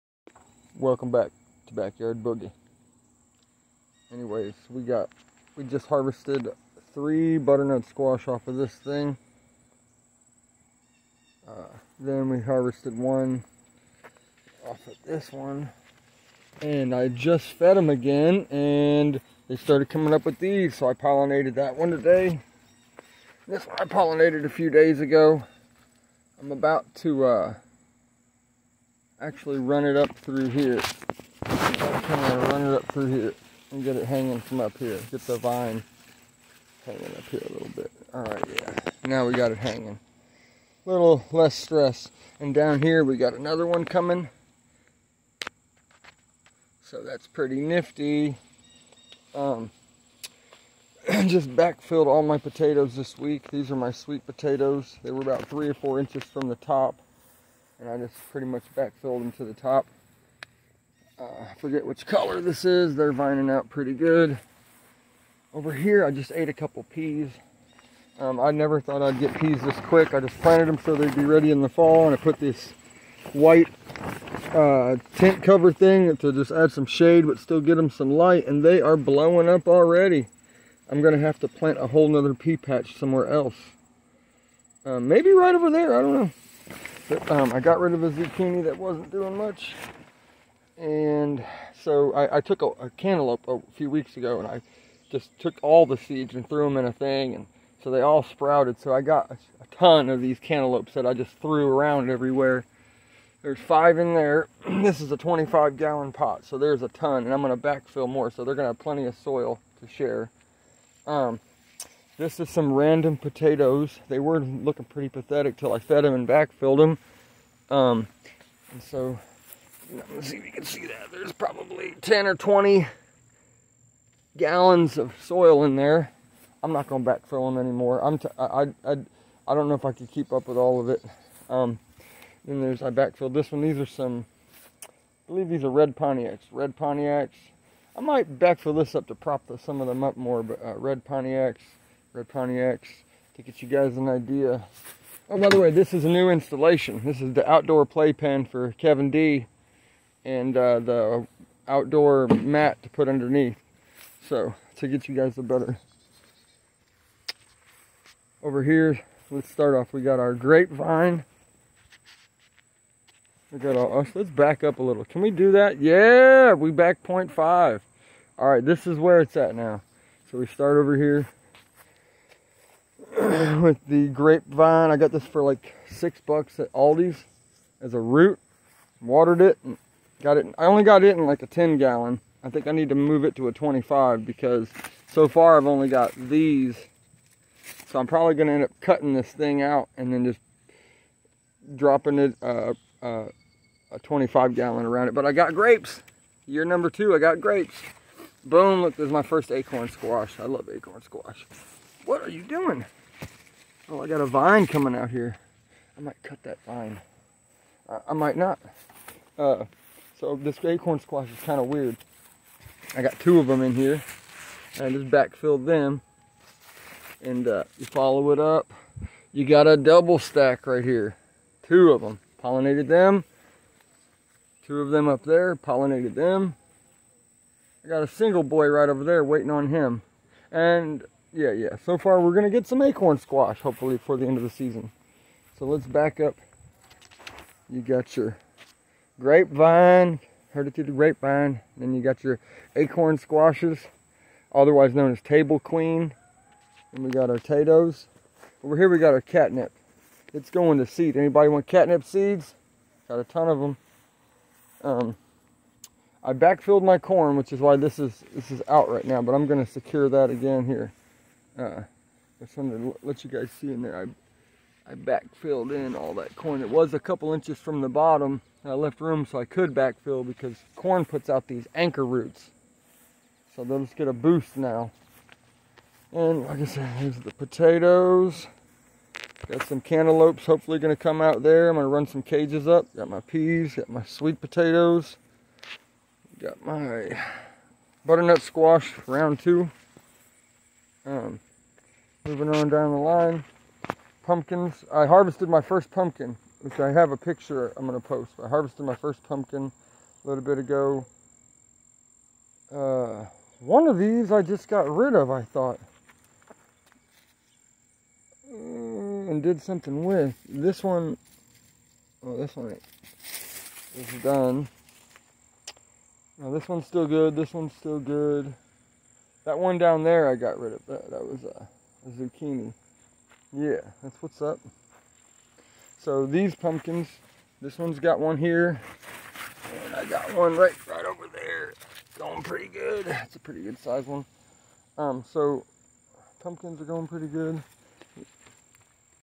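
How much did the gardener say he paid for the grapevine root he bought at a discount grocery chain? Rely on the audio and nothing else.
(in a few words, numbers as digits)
6 dollars.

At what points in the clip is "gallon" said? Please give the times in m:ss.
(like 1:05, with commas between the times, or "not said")
1:45, 2:04, 3:01, 3:14.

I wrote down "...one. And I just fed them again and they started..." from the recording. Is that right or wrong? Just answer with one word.
right.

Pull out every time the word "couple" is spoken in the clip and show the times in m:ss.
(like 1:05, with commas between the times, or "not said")
1:06, 4:26.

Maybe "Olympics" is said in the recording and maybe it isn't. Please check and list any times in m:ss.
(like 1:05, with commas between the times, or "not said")
not said.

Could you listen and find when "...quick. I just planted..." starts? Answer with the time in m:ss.
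1:09.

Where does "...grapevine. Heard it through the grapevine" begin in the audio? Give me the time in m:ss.
3:59.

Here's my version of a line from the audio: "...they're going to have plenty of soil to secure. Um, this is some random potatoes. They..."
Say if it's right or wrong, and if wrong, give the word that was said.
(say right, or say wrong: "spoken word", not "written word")
wrong: "share", not "secure".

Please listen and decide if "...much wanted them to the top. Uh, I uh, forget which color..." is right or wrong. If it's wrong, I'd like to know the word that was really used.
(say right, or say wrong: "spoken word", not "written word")
wrong: "backfilled", not "wanted".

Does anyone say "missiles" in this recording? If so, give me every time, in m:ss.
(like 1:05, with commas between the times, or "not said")
not said.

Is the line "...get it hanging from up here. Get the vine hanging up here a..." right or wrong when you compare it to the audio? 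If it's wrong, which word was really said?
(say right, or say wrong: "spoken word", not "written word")
right.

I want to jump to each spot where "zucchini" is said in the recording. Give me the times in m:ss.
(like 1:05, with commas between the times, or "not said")
1:28, 5:22.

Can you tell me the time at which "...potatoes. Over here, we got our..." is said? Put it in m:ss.
4:07.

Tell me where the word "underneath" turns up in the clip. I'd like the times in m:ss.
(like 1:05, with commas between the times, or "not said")
2:33.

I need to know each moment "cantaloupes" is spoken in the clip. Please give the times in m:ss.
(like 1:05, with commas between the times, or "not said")
1:32, 1:40, 4:39.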